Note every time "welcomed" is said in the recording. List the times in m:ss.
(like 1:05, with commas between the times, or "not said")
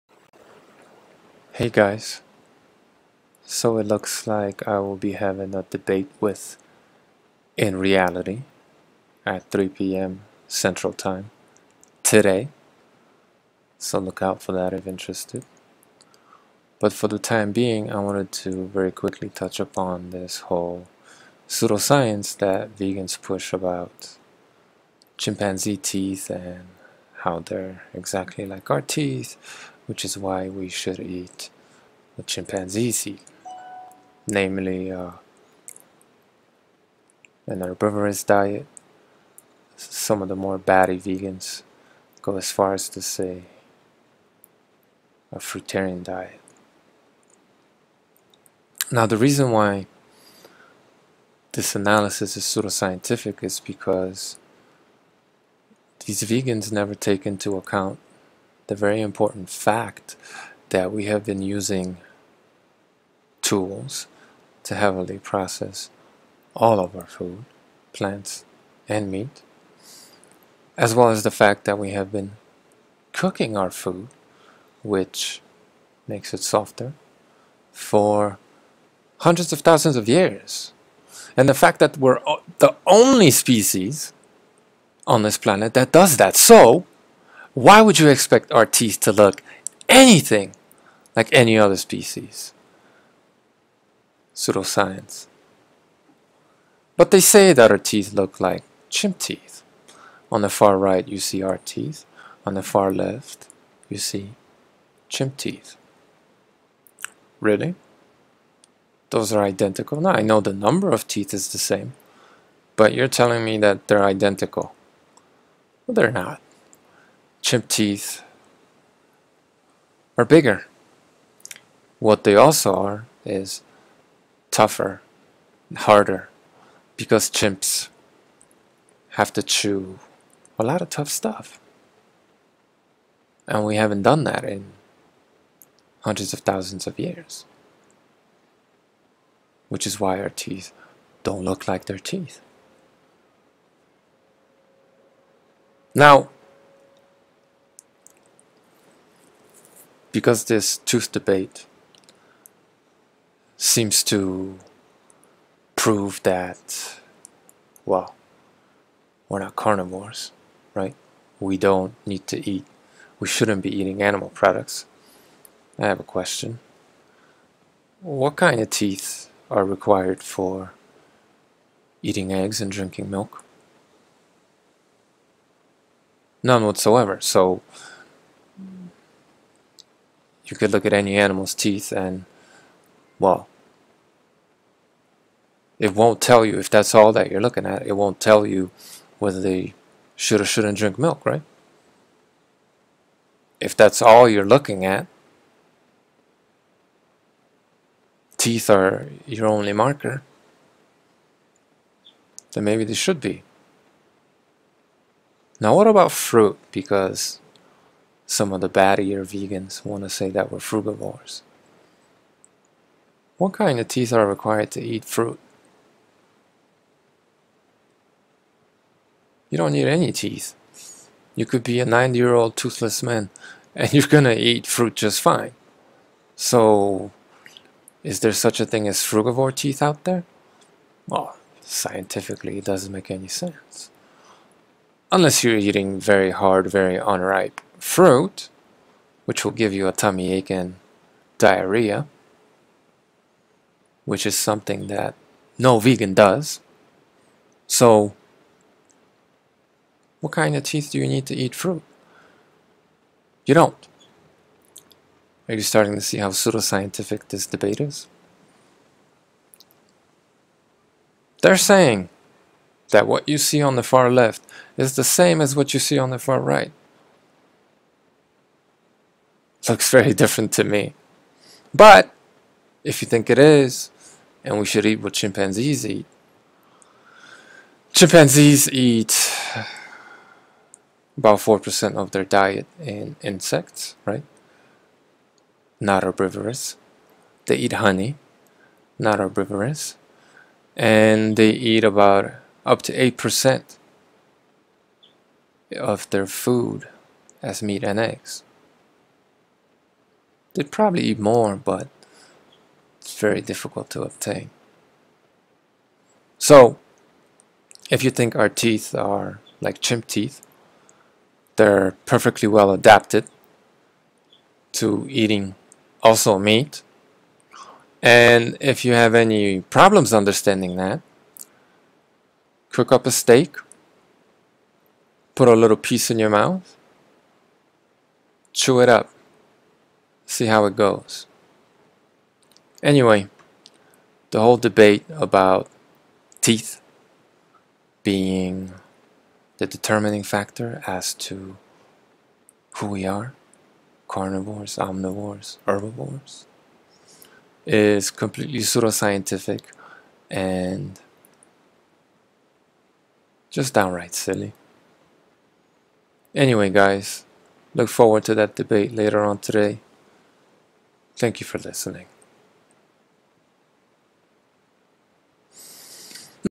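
not said.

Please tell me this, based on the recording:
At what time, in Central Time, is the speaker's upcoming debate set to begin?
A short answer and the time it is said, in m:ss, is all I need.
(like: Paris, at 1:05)
3 p.m., at 0:09.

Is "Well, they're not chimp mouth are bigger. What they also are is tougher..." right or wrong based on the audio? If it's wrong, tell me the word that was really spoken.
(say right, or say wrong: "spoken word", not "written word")
wrong: "teeth", not "mouth".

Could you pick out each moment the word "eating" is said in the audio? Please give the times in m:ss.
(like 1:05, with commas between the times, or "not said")
2:43, 2:52, 3:55, 5:15.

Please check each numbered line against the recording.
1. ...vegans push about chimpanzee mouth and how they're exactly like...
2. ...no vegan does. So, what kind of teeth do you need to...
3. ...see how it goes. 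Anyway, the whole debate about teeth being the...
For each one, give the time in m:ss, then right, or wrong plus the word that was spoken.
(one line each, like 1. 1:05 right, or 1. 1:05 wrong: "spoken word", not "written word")
1. 0:22 wrong: "teeth", not "mouth"
2. 4:05 right
3. 5:30 right.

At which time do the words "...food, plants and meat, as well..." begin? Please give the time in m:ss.
1:07.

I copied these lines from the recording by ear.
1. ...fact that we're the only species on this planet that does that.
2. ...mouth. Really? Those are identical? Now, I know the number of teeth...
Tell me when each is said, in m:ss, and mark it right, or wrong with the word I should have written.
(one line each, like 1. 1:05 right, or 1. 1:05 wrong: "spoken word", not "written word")
1. 1:21 right
2. 1:45 wrong: "teeth", not "mouth".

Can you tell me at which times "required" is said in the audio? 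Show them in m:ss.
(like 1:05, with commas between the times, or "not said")
2:49, 3:34.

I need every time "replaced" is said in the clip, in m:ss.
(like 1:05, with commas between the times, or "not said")
not said.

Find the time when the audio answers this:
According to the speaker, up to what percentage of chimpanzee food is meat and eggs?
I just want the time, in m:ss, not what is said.
4:53.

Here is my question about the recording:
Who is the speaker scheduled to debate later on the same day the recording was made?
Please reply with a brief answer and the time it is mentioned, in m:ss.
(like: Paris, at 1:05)
In Reality, at 0:07.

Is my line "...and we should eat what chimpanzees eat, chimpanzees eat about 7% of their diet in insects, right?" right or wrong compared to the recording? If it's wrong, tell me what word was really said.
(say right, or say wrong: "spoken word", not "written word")
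wrong: "4", not "7".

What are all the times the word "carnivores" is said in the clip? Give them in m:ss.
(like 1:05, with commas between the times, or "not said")
2:39, 5:44.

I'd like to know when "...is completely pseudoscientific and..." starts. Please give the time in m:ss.
5:47.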